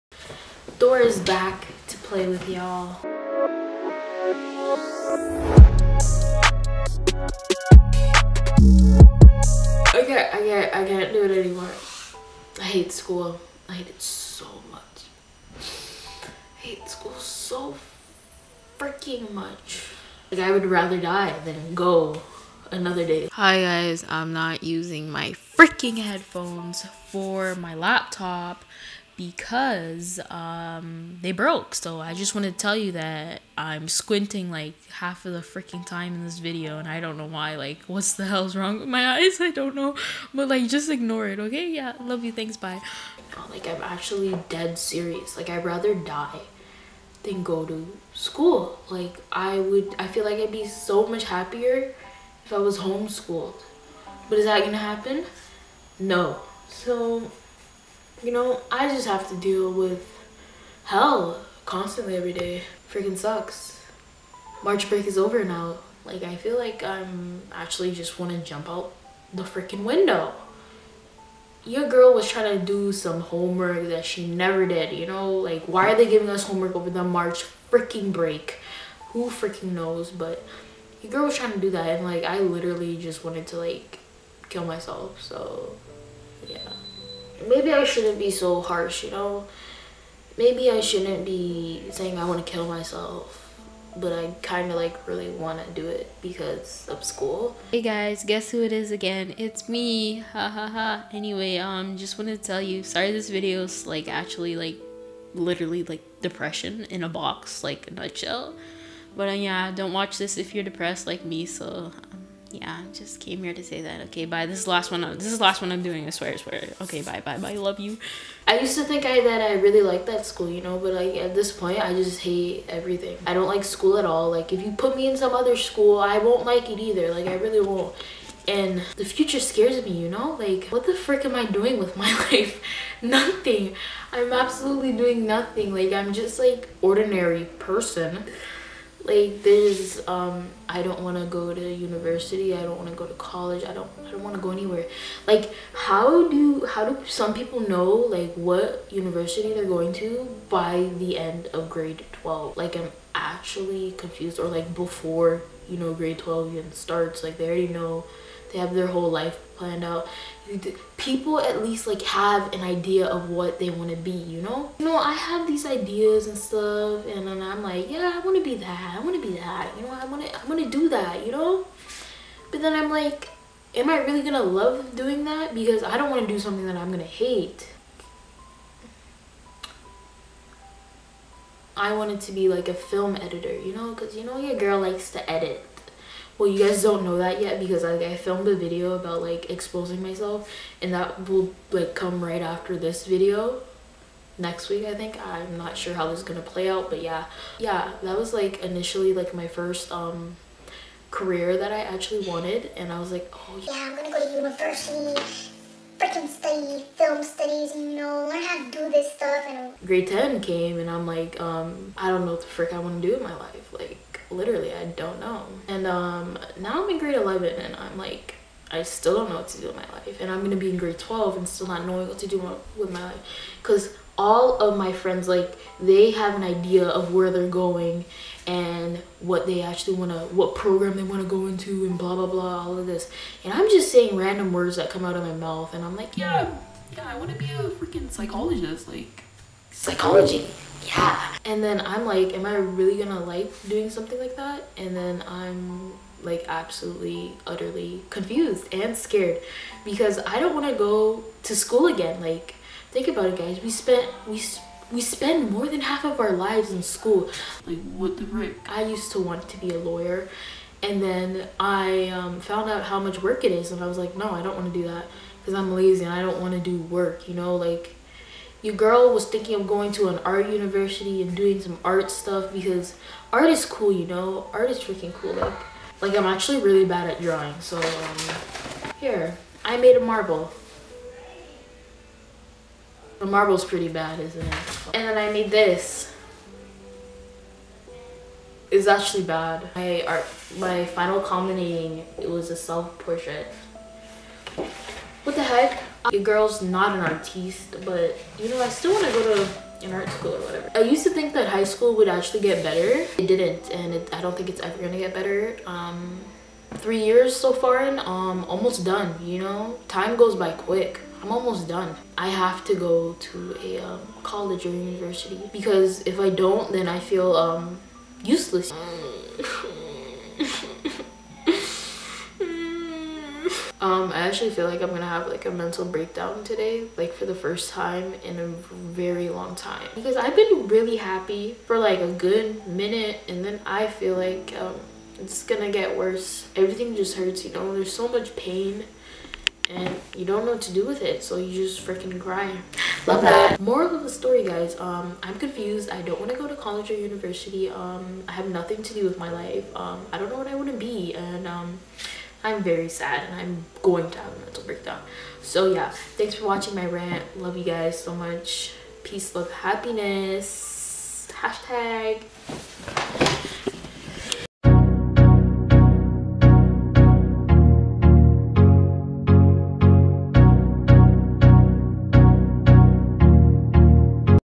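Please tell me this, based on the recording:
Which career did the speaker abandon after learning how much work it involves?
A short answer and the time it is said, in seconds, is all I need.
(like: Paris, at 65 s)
Lawyer, at 259 s.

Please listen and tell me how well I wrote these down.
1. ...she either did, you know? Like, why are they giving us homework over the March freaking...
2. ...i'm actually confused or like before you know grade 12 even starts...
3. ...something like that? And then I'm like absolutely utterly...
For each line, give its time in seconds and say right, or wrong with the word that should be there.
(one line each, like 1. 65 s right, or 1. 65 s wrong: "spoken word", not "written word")
1. 74 s wrong: "never", not "either"
2. 152 s right
3. 243 s right.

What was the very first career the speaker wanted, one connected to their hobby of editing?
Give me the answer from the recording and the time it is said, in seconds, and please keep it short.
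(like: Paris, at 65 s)
Film editor, at 182 s.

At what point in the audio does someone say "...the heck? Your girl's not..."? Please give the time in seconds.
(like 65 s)
295 s.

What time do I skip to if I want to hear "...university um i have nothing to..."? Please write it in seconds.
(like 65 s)
346 s.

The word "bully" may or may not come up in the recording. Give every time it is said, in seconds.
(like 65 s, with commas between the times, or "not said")
not said.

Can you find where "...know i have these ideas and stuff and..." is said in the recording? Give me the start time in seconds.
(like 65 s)
164 s.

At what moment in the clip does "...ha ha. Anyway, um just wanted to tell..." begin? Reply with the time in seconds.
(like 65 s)
100 s.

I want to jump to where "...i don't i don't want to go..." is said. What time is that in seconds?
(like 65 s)
143 s.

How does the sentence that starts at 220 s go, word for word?
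And I'm gonna be in grade 12 and still not knowing what to do with my life.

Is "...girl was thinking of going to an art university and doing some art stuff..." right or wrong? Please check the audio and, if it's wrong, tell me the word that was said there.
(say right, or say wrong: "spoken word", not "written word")
right.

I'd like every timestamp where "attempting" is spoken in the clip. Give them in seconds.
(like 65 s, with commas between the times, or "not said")
not said.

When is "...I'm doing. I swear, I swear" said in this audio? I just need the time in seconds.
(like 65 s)
115 s.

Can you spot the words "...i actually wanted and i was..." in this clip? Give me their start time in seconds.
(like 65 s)
201 s.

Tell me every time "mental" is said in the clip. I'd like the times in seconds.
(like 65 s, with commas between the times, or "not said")
325 s, 354 s.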